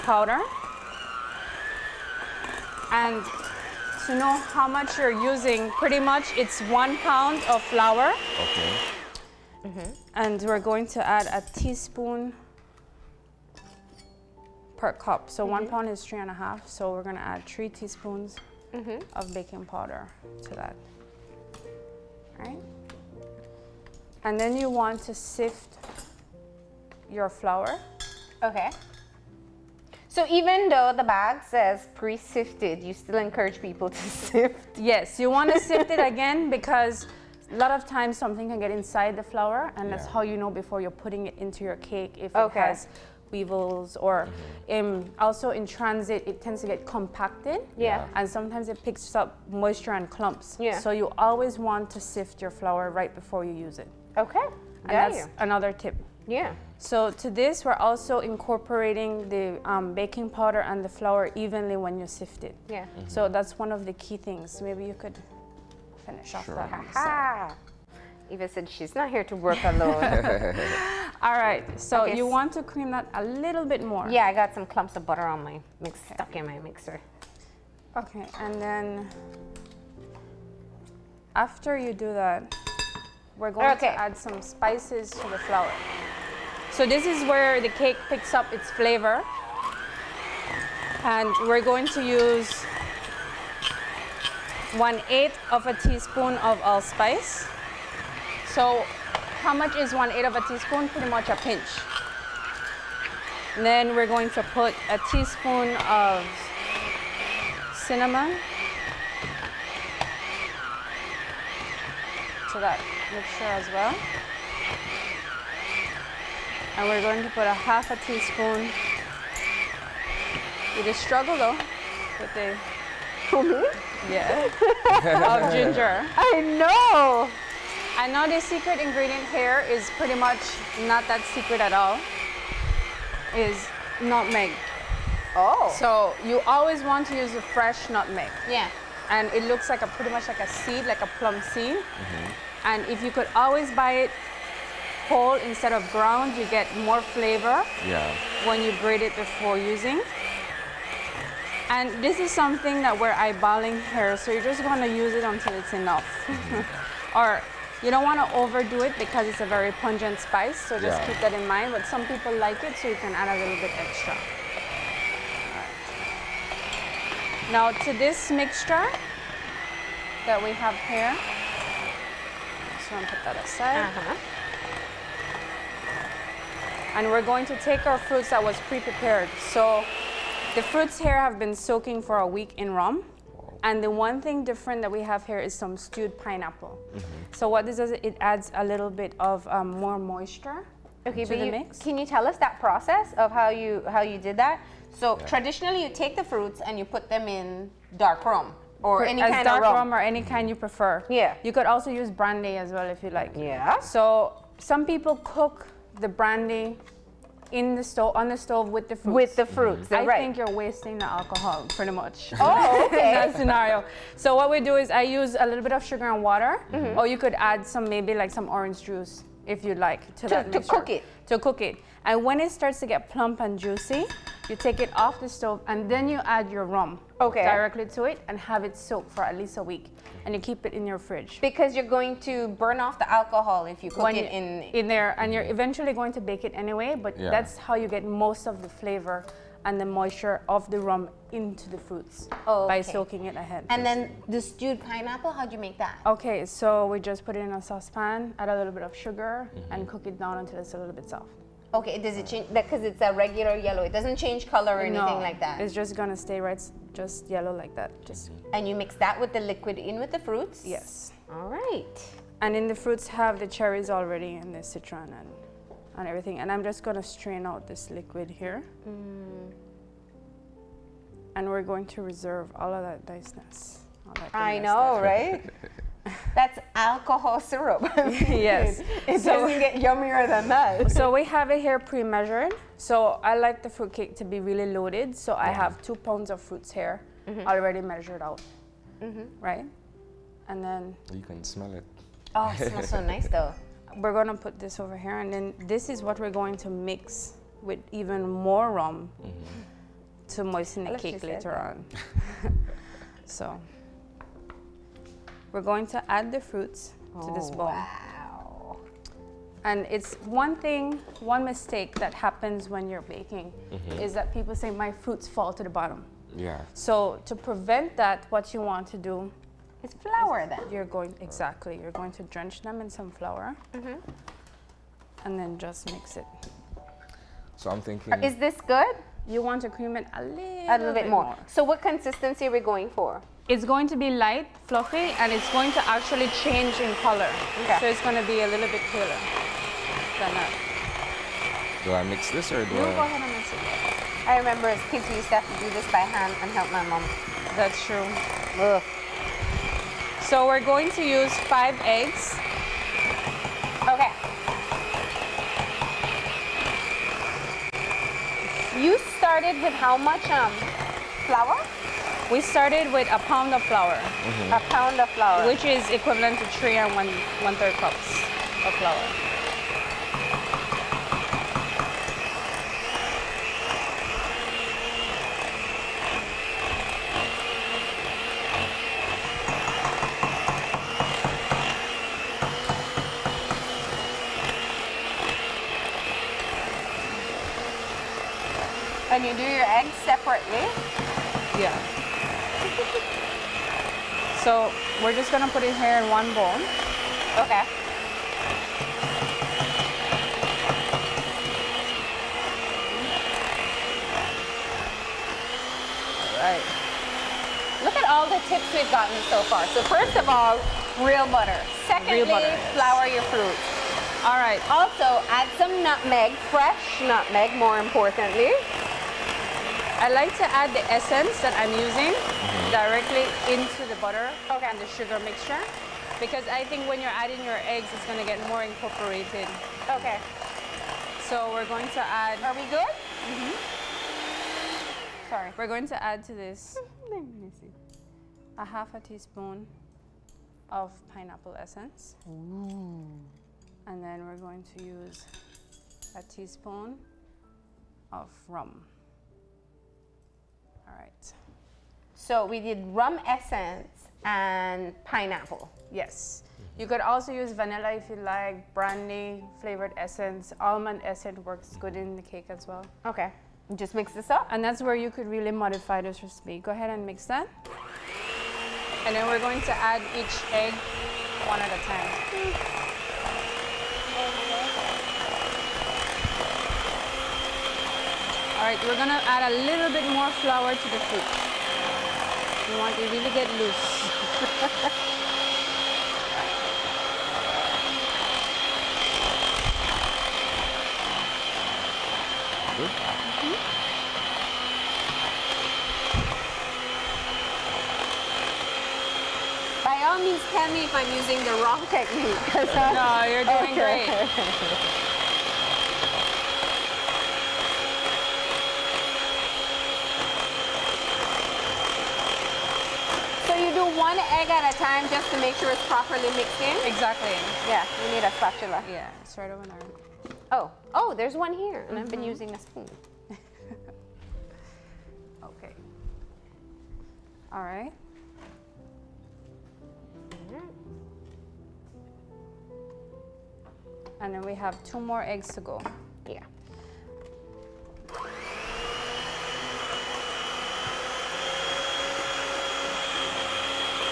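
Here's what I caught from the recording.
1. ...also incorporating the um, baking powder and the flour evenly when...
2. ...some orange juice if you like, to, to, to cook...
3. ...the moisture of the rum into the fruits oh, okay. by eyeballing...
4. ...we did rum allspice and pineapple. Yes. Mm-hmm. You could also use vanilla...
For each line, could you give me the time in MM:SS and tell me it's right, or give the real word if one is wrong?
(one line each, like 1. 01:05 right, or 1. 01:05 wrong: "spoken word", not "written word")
1. 00:57 right
2. 03:38 right
3. 03:59 wrong: "soaking", not "eyeballing"
4. 07:32 wrong: "essence", not "allspice".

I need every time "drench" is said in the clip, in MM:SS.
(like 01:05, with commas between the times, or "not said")
05:22.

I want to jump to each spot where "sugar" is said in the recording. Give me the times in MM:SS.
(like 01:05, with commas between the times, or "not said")
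03:35, 04:08, 07:04.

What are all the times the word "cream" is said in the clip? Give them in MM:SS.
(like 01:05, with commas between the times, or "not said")
01:12, 05:29.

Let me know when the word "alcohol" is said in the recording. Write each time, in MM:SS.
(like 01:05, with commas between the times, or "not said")
03:31, 03:53, 04:36.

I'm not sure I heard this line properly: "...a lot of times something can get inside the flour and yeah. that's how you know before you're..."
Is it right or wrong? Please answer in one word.
right.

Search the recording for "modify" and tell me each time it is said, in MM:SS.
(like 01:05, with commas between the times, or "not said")
07:45.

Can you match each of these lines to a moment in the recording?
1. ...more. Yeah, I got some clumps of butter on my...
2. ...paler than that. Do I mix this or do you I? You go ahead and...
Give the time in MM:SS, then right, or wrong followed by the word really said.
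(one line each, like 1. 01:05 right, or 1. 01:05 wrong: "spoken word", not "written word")
1. 01:13 right
2. 05:38 right.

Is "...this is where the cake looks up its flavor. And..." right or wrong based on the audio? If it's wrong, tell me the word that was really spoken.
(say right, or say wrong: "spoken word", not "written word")
wrong: "picks", not "looks".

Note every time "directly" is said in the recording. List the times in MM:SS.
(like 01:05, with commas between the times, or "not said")
03:47, 07:02.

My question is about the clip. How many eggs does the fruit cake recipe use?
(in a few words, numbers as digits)
5.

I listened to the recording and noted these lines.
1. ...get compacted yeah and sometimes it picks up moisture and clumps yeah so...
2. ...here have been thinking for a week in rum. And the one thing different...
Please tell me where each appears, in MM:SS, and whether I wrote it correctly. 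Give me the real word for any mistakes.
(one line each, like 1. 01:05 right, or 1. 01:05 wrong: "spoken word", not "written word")
1. 00:46 right
2. 03:01 wrong: "soaking", not "thinking".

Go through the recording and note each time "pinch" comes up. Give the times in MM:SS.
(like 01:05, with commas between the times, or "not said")
01:41.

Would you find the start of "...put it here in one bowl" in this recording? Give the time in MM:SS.
06:35.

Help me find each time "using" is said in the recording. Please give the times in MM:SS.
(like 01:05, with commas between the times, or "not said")
00:05, 02:29, 07:01, 08:21, 08:42.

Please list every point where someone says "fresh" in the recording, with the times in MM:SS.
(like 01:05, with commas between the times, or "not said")
02:17, 06:56.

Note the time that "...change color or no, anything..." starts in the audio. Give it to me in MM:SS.
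04:14.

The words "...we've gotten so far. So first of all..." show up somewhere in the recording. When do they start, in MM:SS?
06:48.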